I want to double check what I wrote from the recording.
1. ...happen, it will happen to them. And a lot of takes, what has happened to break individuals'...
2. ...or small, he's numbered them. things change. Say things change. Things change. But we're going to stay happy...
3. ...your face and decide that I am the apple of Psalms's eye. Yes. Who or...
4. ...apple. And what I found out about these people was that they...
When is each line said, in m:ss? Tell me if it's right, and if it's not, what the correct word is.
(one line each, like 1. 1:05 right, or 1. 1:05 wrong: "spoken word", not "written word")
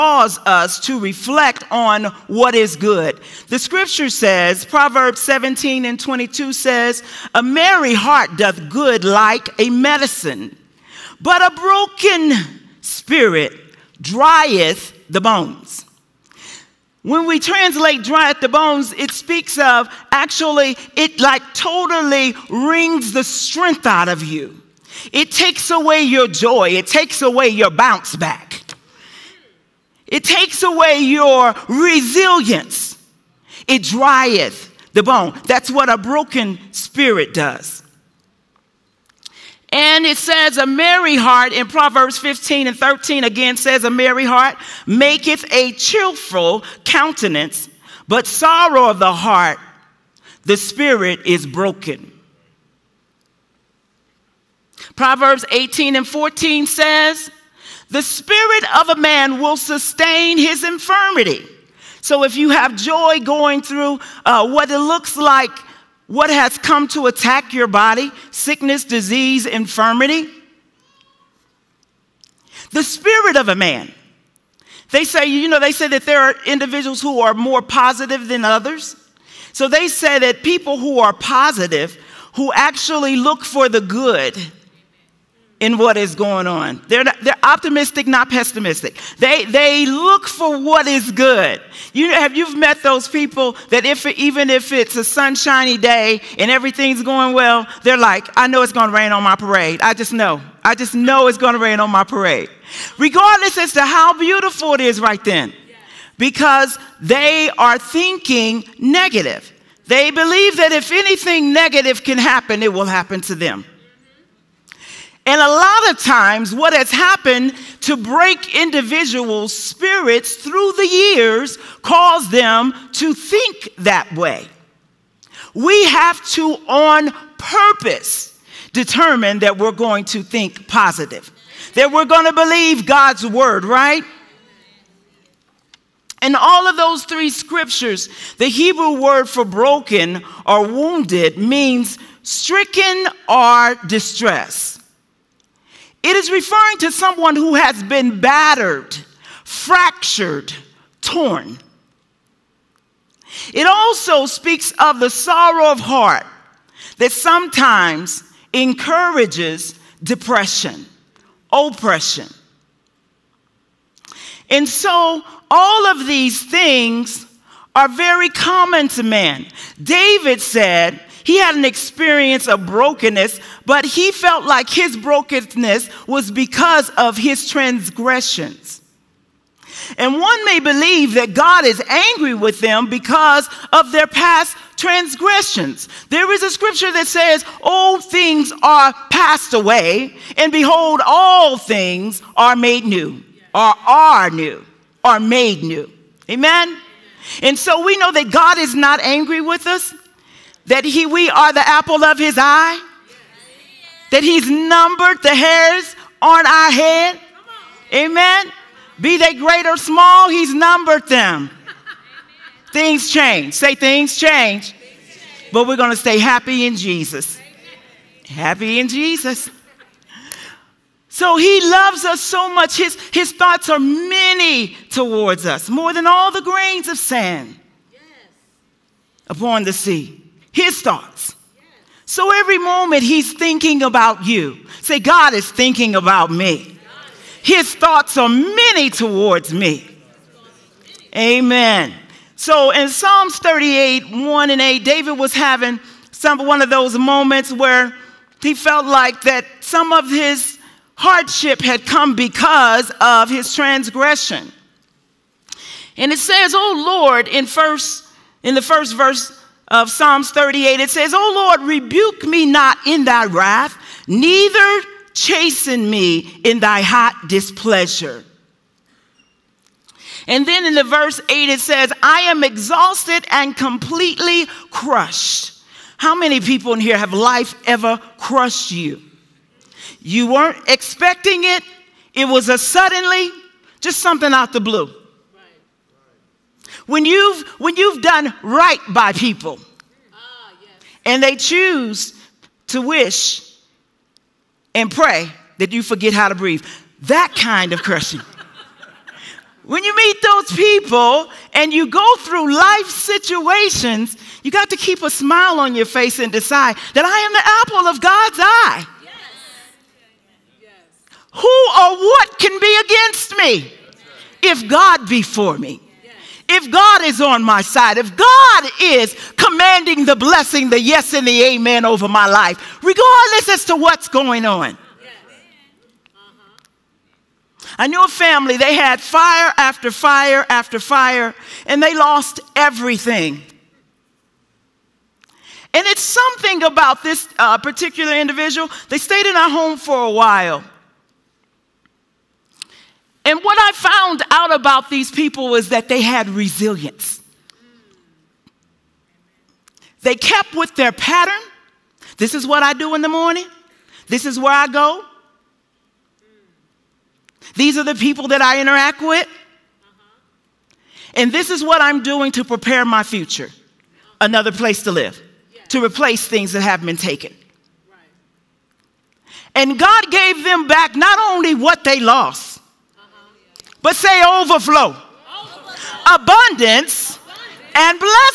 1. 1:52 wrong: "times", not "takes"
2. 3:29 right
3. 5:05 wrong: "God", not "Psalms"
4. 5:40 wrong: "while", not "apple".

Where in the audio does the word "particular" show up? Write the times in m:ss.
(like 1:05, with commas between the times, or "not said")
5:37.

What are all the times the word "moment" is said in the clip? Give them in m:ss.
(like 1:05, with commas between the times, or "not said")
3:52, 4:06.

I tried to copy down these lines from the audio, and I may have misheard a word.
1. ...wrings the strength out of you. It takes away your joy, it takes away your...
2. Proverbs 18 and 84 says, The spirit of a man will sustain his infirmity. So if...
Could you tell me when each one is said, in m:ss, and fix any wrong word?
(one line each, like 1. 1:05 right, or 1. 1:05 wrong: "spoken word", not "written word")
1. 0:22 right
2. 0:54 wrong: "14", not "84".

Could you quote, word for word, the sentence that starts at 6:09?
And God gave them back not only what they lost, but say overflow.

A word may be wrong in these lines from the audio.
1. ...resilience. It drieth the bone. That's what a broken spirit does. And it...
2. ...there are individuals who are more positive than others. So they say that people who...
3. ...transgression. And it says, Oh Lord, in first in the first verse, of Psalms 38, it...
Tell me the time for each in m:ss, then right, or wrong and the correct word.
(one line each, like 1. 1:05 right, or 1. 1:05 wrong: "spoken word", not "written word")
1. 0:31 right
2. 1:16 right
3. 4:13 right.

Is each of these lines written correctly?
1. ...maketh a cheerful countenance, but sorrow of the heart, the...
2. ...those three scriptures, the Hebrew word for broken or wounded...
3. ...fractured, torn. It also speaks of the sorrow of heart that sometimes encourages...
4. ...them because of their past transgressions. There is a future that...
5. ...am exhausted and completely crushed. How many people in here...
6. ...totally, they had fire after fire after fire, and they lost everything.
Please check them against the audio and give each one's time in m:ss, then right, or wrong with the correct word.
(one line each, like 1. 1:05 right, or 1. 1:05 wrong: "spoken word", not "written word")
1. 0:44 right
2. 2:16 right
3. 2:29 right
4. 3:02 wrong: "scripture", not "future"
5. 4:32 right
6. 5:28 wrong: "family", not "totally".